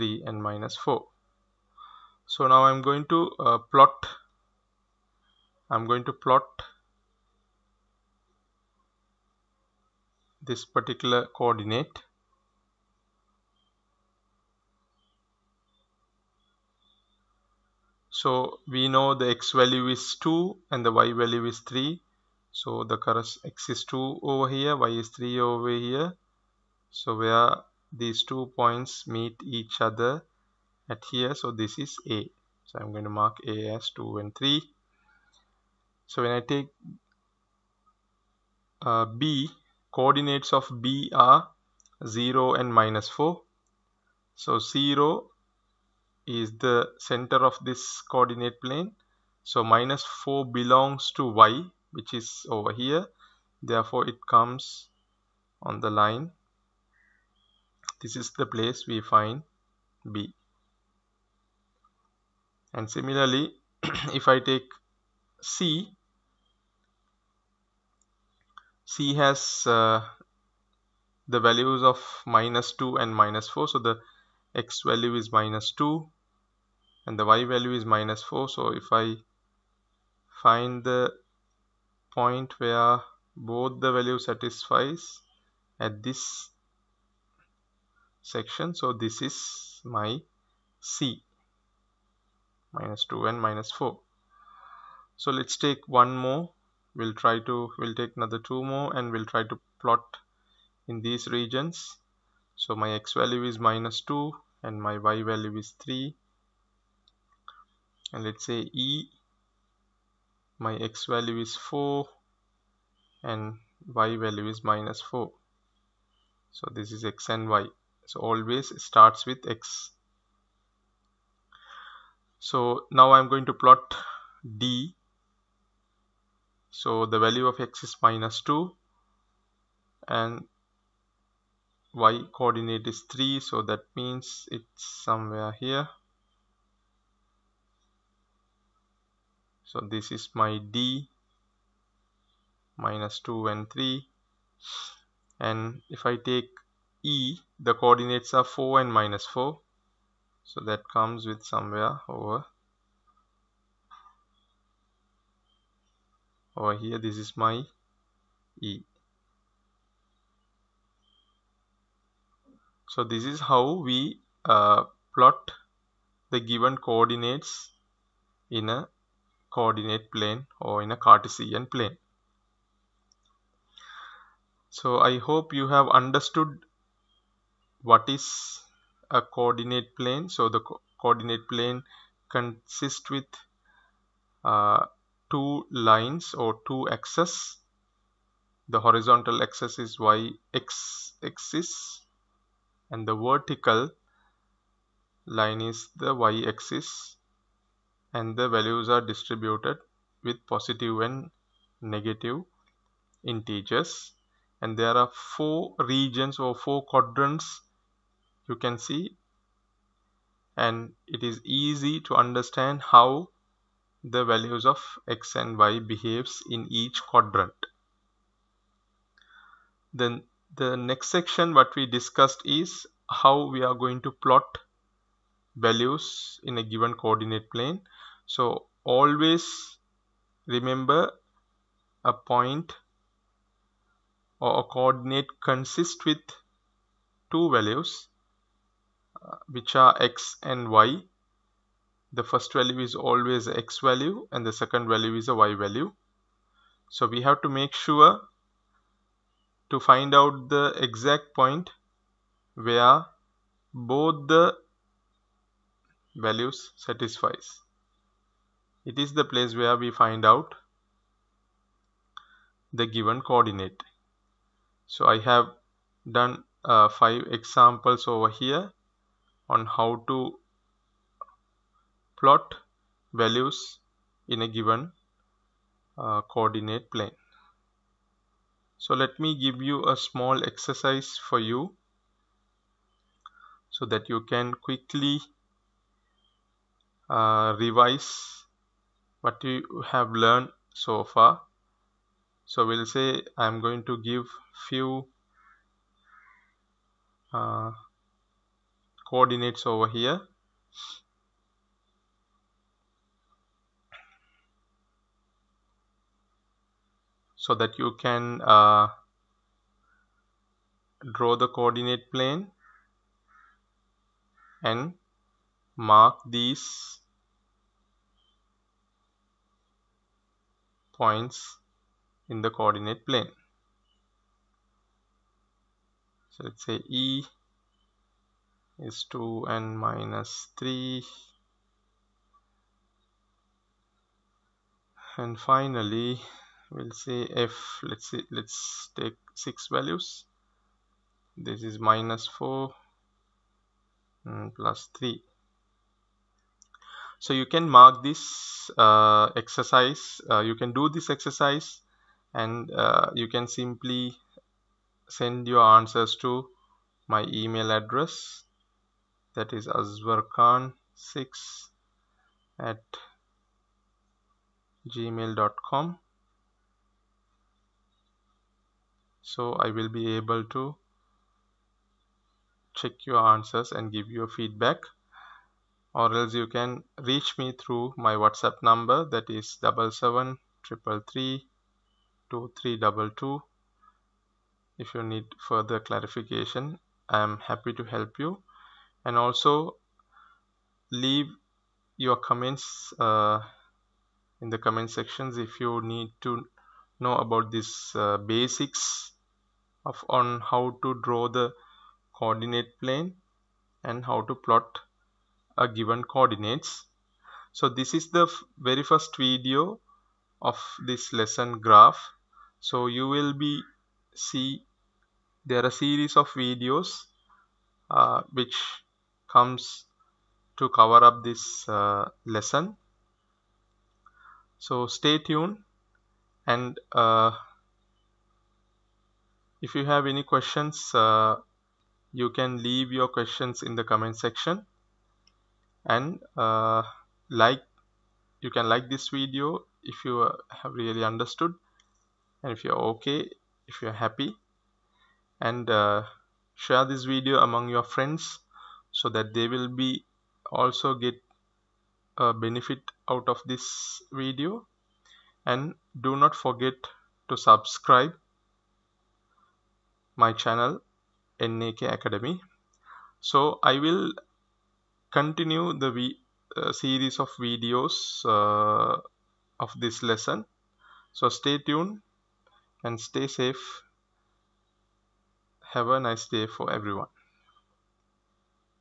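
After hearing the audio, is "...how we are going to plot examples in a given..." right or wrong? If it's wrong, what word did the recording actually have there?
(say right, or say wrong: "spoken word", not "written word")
wrong: "values", not "examples".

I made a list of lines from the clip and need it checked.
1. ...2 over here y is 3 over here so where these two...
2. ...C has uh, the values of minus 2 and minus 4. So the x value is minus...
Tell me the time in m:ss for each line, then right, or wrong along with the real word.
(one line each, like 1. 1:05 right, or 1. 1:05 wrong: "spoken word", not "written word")
1. 0:23 right
2. 1:08 right.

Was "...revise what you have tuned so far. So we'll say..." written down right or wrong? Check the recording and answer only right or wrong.
wrong.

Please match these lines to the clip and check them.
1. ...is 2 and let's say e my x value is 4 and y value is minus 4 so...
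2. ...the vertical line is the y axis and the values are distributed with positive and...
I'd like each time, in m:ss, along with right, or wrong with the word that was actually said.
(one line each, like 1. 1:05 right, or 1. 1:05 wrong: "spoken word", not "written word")
1. 1:45 wrong: "3", not "2"
2. 3:13 right.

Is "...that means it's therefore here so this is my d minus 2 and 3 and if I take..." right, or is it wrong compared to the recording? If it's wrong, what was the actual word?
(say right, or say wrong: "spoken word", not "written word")
wrong: "somewhere", not "therefore".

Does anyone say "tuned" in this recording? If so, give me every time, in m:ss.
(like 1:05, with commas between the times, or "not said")
7:05, 7:51.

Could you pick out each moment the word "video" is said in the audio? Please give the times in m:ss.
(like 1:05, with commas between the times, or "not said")
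6:49, 6:56, 7:19, 7:27, 7:34, 7:47.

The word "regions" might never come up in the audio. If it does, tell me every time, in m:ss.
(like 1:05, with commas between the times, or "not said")
1:41, 3:25.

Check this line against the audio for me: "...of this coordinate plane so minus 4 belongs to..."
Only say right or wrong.
right.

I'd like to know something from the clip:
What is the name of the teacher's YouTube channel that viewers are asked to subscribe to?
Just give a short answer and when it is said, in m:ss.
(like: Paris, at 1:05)
NAK Academy, at 7:41.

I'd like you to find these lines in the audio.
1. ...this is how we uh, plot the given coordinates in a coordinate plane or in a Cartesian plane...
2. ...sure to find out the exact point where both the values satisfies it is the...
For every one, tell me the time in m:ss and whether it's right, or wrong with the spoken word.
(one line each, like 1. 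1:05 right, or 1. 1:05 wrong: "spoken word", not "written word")
1. 2:43 right
2. 4:07 right.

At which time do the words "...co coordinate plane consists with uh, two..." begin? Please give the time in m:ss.
3:00.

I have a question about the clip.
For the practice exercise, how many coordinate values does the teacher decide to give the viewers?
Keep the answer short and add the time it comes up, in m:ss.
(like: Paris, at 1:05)
6, at 5:39.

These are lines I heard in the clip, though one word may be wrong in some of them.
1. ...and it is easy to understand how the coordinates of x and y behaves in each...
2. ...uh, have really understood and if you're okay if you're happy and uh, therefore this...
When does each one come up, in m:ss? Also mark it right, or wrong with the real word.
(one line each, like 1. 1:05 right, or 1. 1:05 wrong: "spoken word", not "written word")
1. 3:30 wrong: "values", not "coordinates"
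2. 7:20 wrong: "share", not "therefore".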